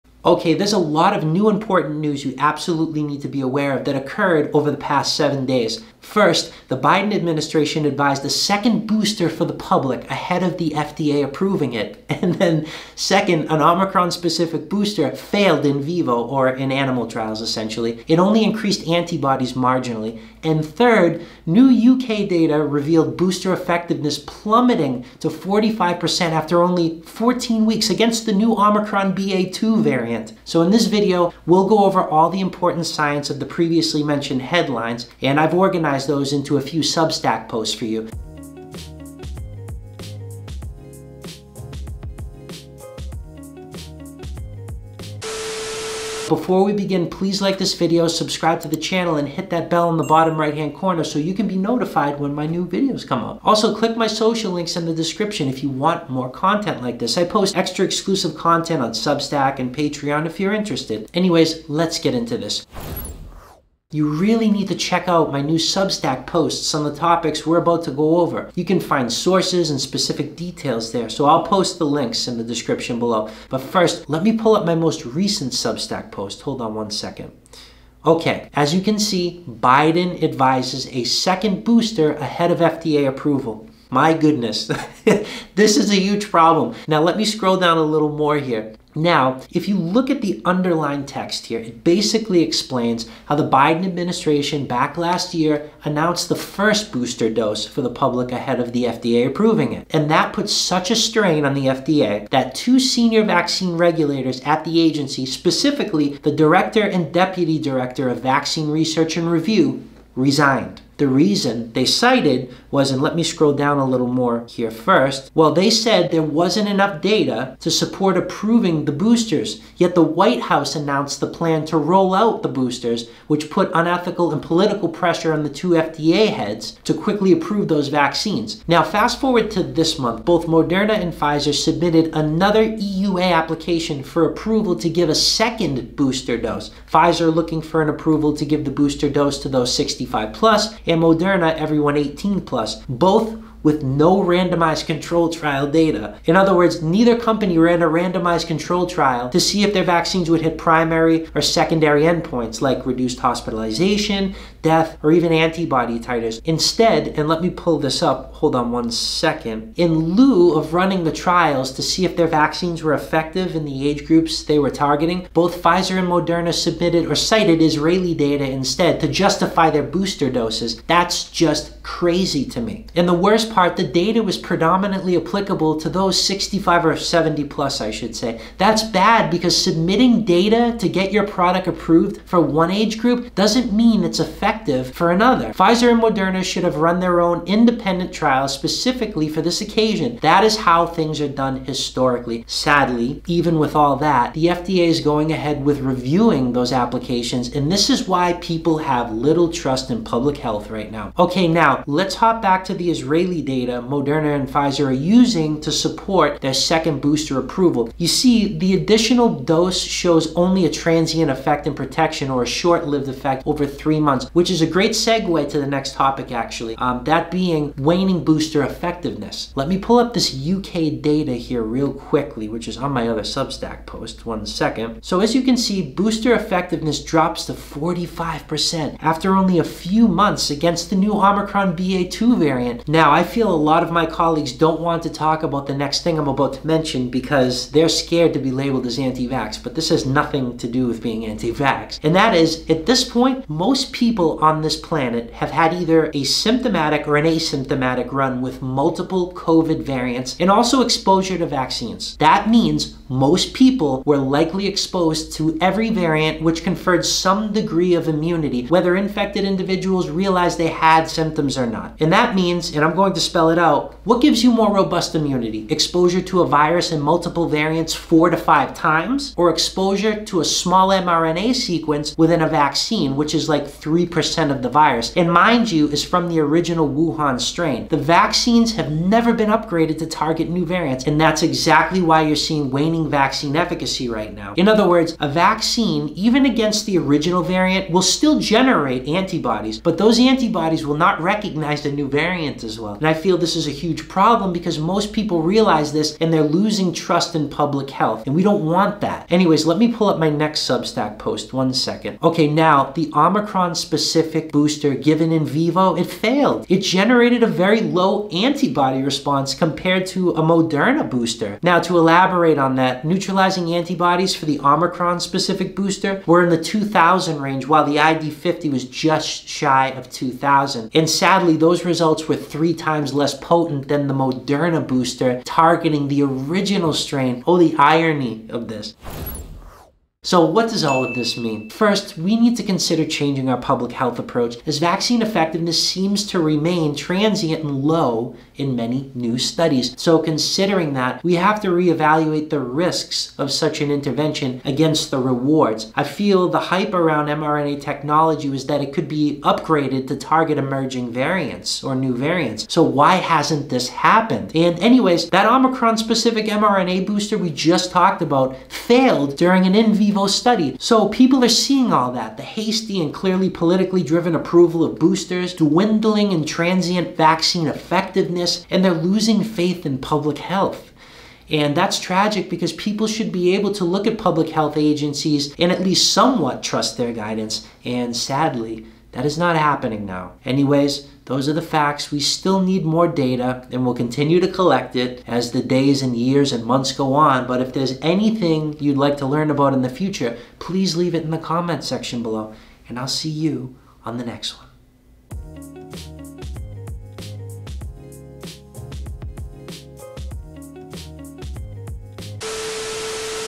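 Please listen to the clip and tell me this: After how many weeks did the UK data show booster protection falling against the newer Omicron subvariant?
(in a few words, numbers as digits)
14 weeks.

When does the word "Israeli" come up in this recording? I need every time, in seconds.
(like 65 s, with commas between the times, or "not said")
167 s, 202 s.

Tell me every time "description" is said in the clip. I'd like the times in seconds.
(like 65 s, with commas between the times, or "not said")
54 s, 72 s.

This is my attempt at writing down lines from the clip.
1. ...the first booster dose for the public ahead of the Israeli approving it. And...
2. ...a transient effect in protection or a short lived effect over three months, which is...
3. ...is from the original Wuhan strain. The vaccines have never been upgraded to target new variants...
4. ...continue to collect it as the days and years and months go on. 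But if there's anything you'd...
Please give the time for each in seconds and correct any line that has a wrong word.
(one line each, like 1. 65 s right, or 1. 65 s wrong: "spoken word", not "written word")
1. 96 s wrong: "FDA", not "Israeli"
2. 210 s right
3. 275 s right
4. 383 s right.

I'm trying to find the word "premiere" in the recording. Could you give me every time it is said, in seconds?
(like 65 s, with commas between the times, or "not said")
not said.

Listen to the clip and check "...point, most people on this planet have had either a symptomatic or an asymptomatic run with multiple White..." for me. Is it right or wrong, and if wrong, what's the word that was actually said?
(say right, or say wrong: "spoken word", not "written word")
wrong: "COVID", not "White".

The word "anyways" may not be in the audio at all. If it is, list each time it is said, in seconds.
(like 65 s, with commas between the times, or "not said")
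61 s, 299 s, 354 s, 380 s.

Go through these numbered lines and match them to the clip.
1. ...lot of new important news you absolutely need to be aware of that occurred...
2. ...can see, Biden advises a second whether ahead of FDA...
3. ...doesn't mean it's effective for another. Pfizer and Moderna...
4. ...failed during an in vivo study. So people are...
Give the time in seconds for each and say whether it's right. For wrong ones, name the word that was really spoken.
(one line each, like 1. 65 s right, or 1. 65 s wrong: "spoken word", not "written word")
1. 0 s right
2. 78 s wrong: "booster", not "whether"
3. 183 s right
4. 358 s right.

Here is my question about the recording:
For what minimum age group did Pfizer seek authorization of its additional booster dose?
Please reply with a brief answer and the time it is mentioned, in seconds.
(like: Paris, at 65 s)
65 plus, at 139 s.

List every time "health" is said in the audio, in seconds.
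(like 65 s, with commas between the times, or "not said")
200 s, 297 s, 333 s, 370 s, 374 s.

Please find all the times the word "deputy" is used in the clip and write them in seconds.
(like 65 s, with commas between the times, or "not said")
107 s.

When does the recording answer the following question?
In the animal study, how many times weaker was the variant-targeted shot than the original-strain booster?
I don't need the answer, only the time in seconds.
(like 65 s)
322 s.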